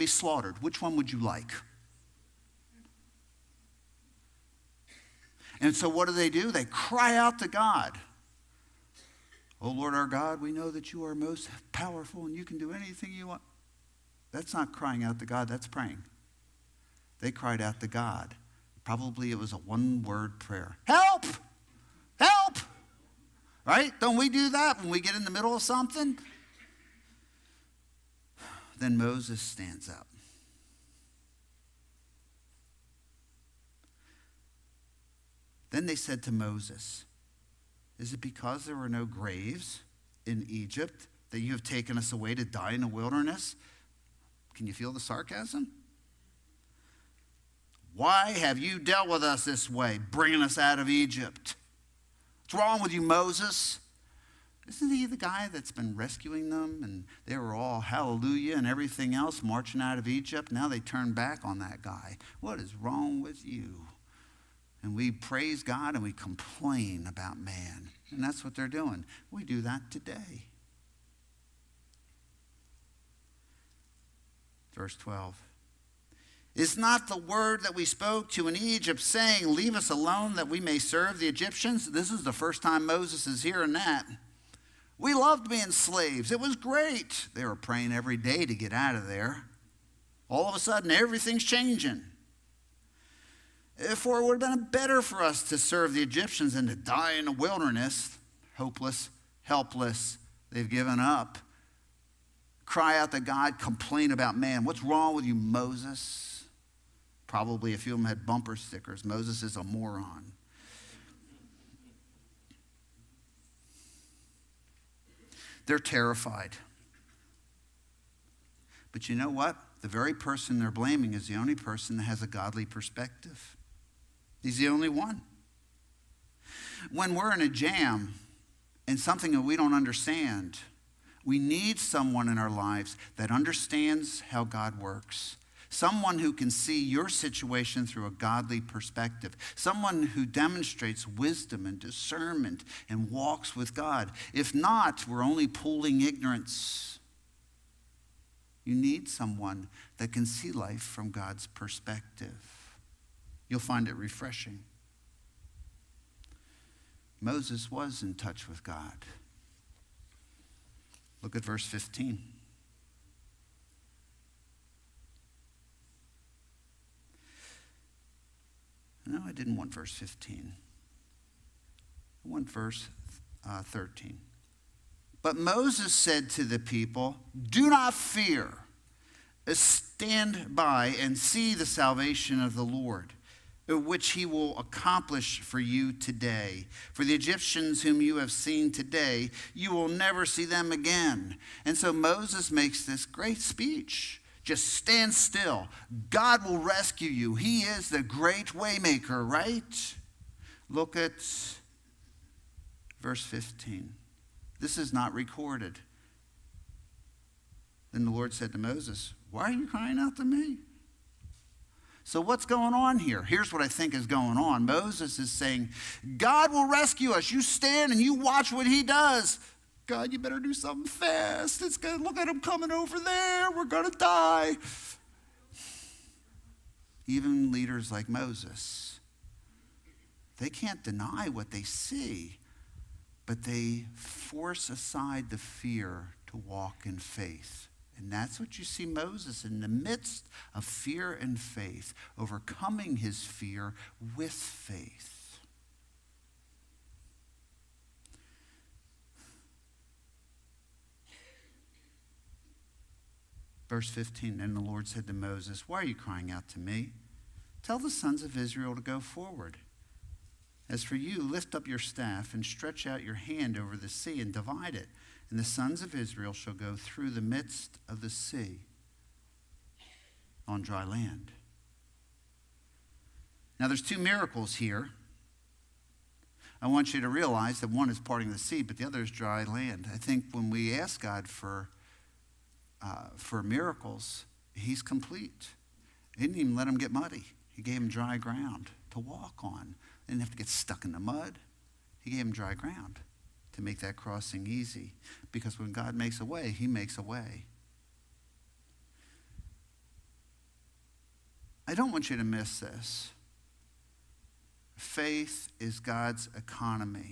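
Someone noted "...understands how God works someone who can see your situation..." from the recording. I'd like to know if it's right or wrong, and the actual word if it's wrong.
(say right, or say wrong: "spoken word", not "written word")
right.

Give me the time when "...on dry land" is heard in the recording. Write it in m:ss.
4:30.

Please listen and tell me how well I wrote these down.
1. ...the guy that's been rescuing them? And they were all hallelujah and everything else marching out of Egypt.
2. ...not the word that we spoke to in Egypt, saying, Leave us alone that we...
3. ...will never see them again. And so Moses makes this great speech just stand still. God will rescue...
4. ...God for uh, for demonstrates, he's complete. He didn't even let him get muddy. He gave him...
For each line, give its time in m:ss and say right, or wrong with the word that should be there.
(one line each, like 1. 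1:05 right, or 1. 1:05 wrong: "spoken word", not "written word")
1. 0:55 right
2. 1:16 right
3. 3:09 right
4. 4:40 wrong: "miracles", not "demonstrates".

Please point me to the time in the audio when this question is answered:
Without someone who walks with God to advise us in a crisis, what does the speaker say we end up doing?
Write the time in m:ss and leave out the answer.
2:25.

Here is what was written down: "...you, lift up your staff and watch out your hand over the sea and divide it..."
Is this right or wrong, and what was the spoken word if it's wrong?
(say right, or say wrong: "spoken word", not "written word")
wrong: "stretch", not "watch".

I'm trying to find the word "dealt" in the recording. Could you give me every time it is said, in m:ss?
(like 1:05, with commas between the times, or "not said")
0:48.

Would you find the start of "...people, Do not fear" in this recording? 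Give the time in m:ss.
2:56.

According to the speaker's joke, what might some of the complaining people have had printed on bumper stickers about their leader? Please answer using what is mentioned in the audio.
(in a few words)
Moses is a moron.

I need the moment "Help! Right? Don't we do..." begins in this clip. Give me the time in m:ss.
0:22.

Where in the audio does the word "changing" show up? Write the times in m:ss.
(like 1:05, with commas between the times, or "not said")
1:31.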